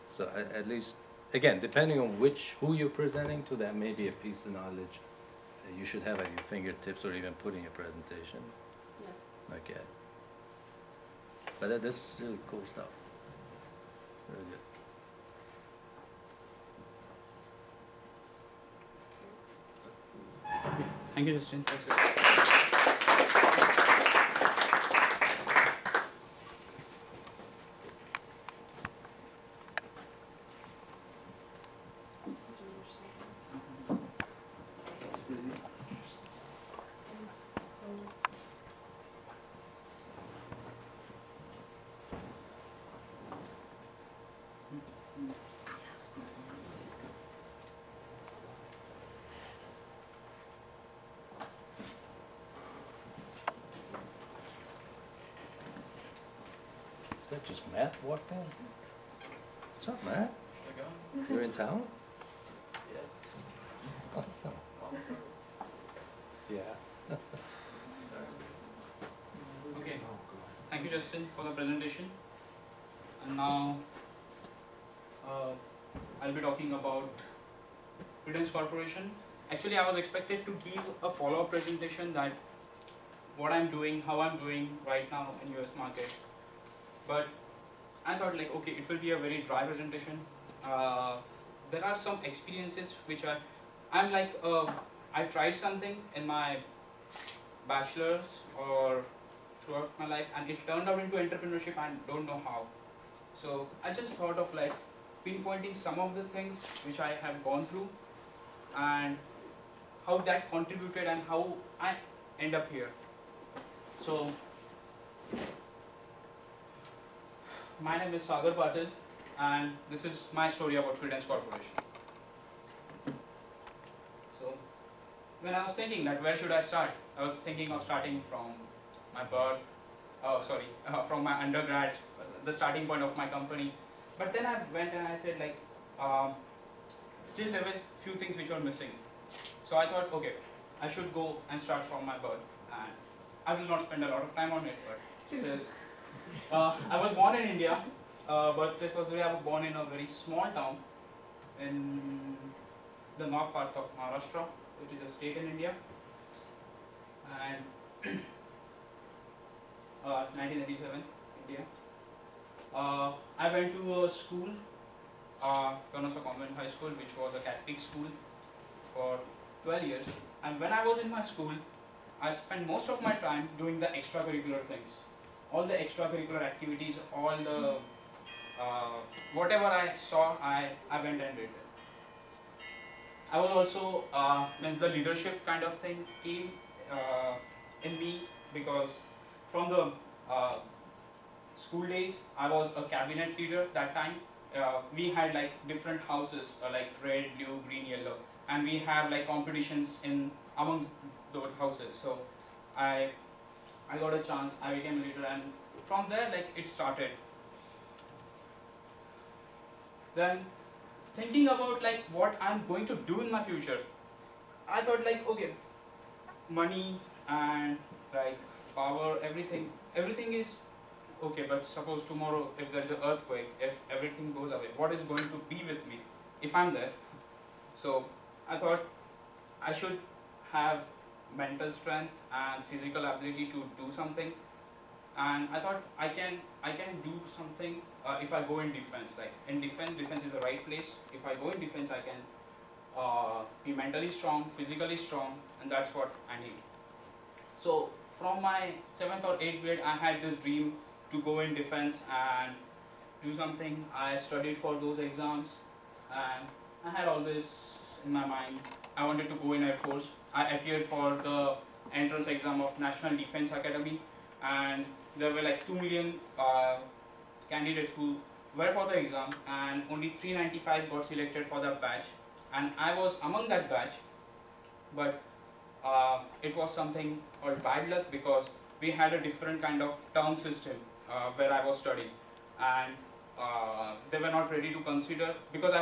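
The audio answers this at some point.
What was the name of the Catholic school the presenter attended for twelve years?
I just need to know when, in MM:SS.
02:45.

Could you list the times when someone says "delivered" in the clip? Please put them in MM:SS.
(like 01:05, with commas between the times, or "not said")
not said.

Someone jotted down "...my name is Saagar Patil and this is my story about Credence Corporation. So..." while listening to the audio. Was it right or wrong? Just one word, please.
right.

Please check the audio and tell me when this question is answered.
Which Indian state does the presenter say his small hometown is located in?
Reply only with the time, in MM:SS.
02:33.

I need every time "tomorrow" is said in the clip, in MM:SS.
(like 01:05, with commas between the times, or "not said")
03:42.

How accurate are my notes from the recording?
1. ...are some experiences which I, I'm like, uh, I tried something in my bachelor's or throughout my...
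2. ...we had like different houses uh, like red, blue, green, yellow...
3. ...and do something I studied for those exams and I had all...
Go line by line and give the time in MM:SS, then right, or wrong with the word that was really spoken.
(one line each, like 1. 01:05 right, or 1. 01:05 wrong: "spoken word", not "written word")
1. 01:31 right
2. 03:14 right
3. 04:12 right.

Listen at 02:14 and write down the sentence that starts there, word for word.
But then I went and I said like, um, still there were few things which were missing.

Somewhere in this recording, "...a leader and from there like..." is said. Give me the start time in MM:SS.
03:25.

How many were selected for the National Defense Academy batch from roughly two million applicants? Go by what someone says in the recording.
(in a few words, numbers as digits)
395.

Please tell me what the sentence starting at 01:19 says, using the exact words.
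Actually, I was expected to give a follow-up presentation that what I'm doing, how I'm doing right now in US market.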